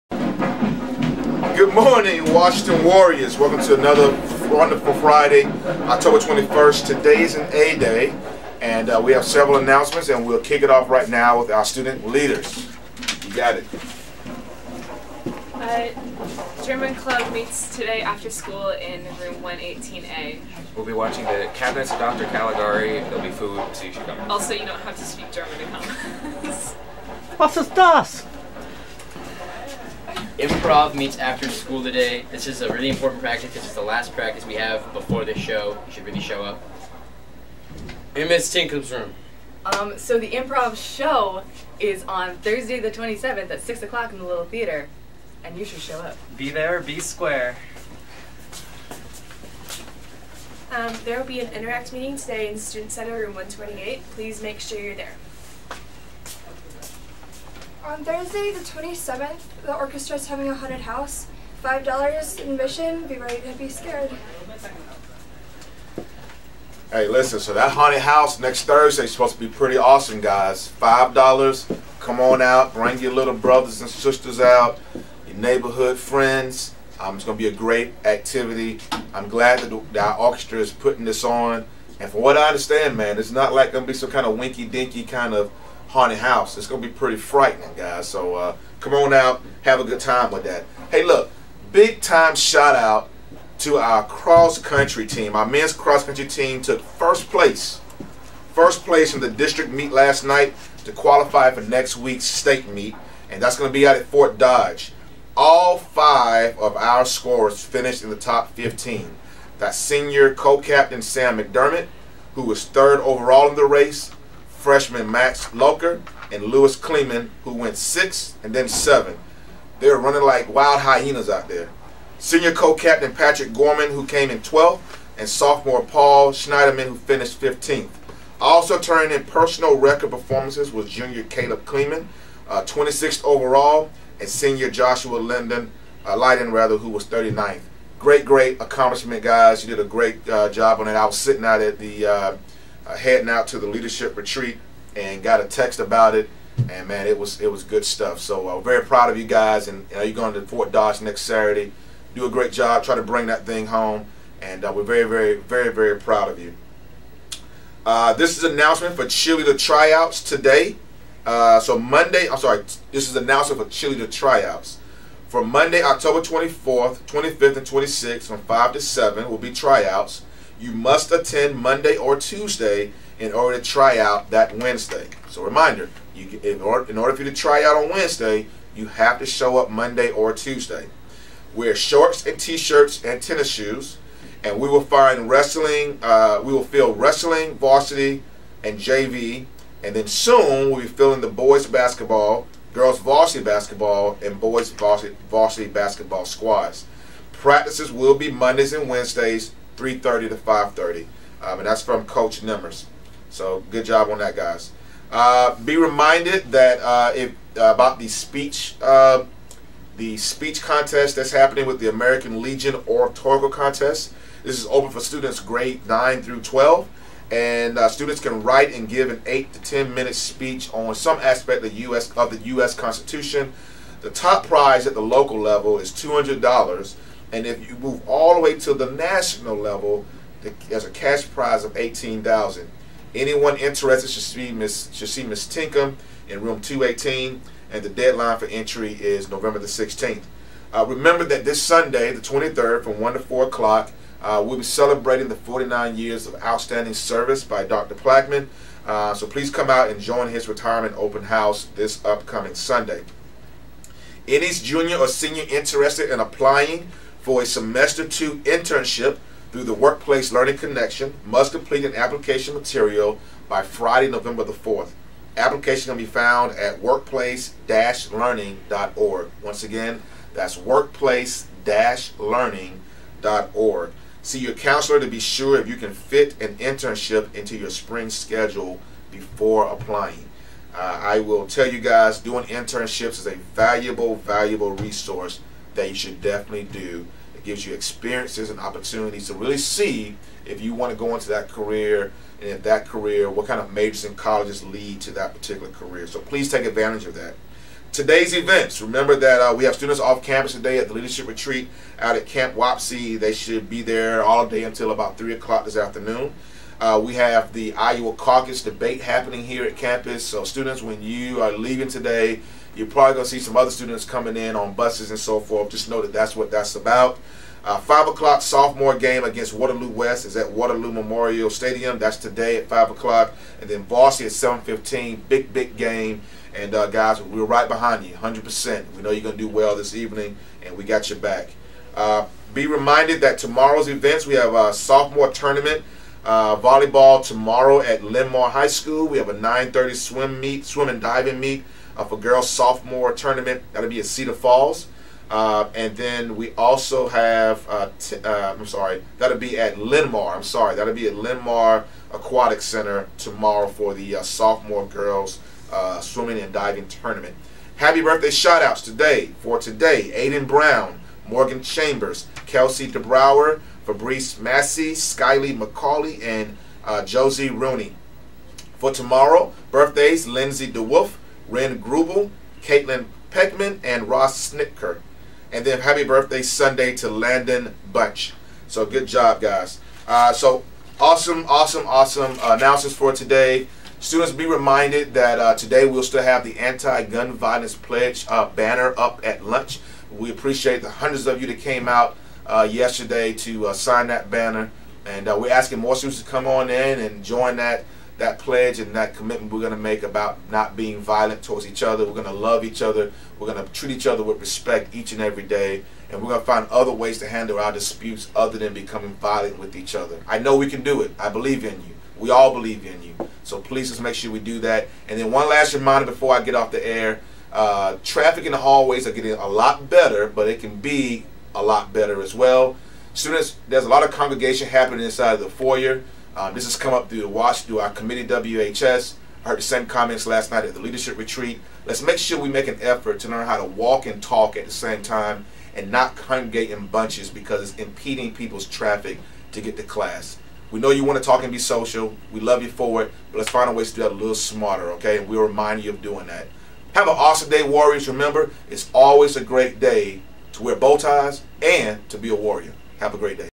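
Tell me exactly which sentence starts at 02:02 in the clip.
Senior co-captain Patrick Gorman, who came in 12th, and sophomore Paul Schneiderman, who finished 15th.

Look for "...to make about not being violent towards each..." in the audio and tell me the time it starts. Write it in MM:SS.
06:39.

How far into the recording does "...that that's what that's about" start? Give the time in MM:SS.
05:16.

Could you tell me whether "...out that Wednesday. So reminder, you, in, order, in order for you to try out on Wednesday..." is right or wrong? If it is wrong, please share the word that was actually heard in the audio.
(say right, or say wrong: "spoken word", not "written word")
right.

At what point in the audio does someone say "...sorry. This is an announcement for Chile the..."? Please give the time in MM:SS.
02:42.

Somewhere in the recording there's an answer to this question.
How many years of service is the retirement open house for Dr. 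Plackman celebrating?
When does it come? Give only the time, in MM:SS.
04:05.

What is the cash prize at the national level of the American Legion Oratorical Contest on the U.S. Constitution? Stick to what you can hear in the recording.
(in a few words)
18,000 dollars.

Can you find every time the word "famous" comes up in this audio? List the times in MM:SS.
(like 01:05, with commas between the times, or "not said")
not said.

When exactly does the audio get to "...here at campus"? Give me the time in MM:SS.
05:09.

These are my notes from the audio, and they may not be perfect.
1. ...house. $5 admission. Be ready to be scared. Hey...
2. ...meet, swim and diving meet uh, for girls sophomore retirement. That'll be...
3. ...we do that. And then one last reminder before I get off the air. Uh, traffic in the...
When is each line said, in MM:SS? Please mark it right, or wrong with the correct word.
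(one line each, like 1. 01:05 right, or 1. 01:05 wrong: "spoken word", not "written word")
1. 01:00 right
2. 05:40 wrong: "tournament", not "retirement"
3. 06:54 right.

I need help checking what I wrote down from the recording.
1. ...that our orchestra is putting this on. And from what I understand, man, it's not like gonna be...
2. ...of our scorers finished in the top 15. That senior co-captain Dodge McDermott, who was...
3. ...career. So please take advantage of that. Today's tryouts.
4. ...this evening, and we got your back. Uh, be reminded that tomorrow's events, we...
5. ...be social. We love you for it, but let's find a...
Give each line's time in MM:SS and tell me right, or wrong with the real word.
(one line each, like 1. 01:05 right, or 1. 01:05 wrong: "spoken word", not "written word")
1. 01:19 right
2. 01:46 wrong: "Sam", not "Dodge"
3. 04:55 wrong: "events", not "tryouts"
4. 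05:29 right
5. 07:21 right.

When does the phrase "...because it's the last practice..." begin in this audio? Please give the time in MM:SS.
00:33.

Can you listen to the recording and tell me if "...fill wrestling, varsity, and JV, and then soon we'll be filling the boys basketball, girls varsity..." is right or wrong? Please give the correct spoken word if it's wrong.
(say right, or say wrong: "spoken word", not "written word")
right.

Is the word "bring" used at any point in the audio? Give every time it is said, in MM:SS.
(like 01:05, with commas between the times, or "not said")
01:12, 02:33.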